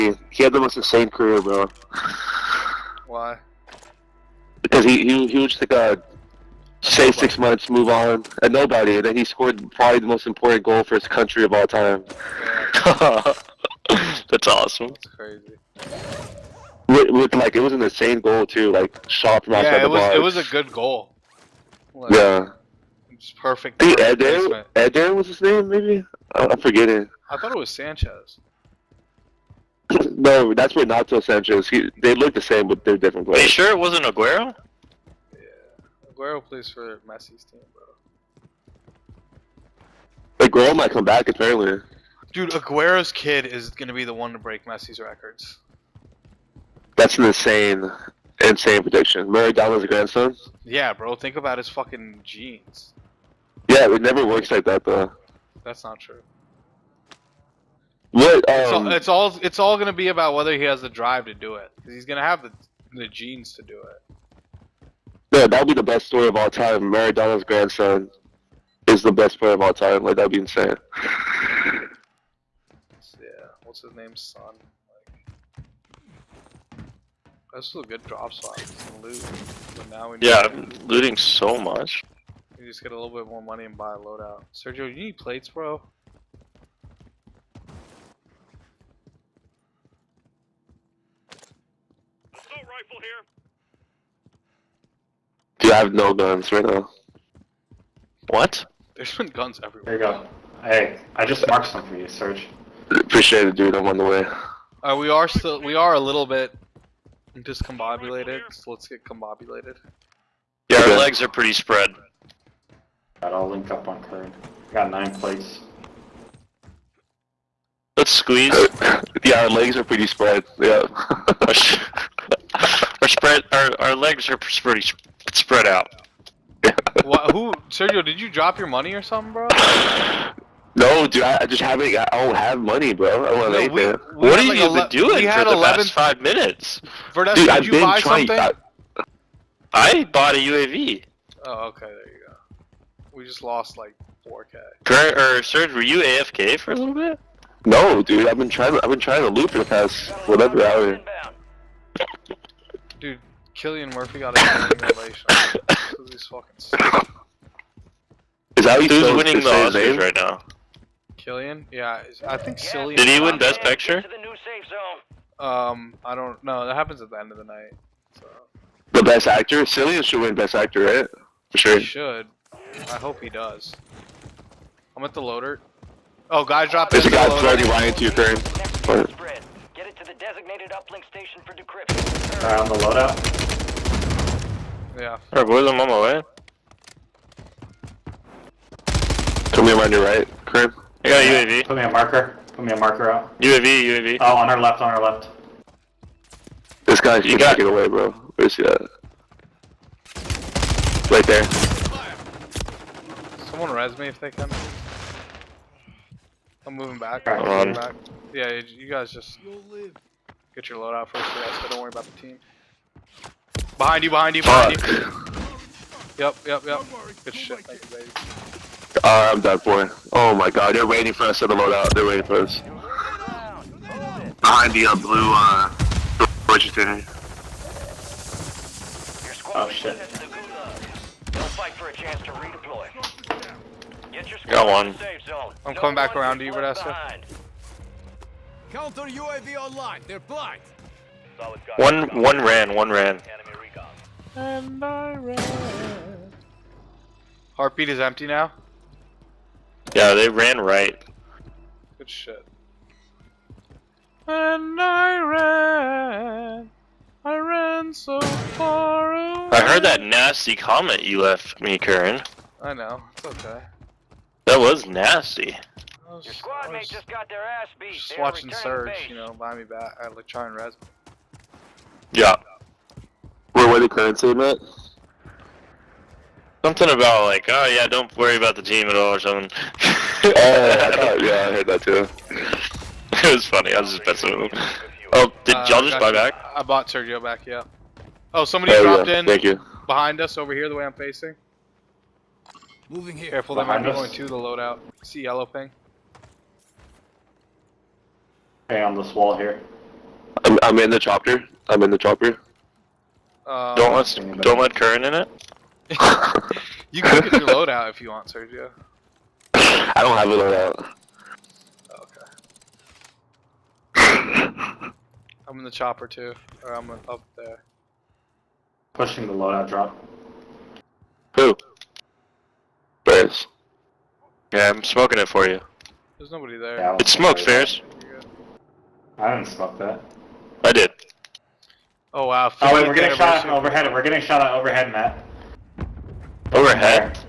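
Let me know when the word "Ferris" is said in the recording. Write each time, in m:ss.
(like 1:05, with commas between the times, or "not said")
5:23, 5:27.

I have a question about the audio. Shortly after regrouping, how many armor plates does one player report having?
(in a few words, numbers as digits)
9.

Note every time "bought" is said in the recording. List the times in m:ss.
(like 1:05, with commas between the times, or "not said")
2:20, 4:46.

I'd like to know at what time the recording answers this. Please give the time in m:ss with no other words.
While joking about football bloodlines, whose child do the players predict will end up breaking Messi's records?
0:42.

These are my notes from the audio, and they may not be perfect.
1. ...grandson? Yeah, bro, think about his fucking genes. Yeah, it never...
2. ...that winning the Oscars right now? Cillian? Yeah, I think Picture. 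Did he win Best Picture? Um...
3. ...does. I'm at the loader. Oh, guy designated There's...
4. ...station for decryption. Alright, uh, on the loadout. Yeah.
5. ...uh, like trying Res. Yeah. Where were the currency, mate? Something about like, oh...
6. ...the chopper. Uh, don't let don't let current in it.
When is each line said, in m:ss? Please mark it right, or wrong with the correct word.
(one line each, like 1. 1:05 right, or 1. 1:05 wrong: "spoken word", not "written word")
1. 0:49 right
2. 2:38 wrong: "Cillian", not "Picture"
3. 2:53 wrong: "dropped", not "designated"
4. 3:01 right
5. 4:30 right
6. 5:01 right.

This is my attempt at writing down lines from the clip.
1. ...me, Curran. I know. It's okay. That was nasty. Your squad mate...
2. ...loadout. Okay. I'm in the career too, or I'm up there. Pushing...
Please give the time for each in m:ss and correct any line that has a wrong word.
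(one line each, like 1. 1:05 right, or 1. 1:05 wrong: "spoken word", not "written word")
1. 4:21 right
2. 5:10 wrong: "chopper", not "career".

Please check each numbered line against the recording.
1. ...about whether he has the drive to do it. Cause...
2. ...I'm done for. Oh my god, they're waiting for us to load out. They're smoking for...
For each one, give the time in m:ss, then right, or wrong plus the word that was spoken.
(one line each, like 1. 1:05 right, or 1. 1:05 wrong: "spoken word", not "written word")
1. 1:00 right
2. 3:39 wrong: "waiting", not "smoking".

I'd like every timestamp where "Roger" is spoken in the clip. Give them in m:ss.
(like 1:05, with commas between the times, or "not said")
3:46.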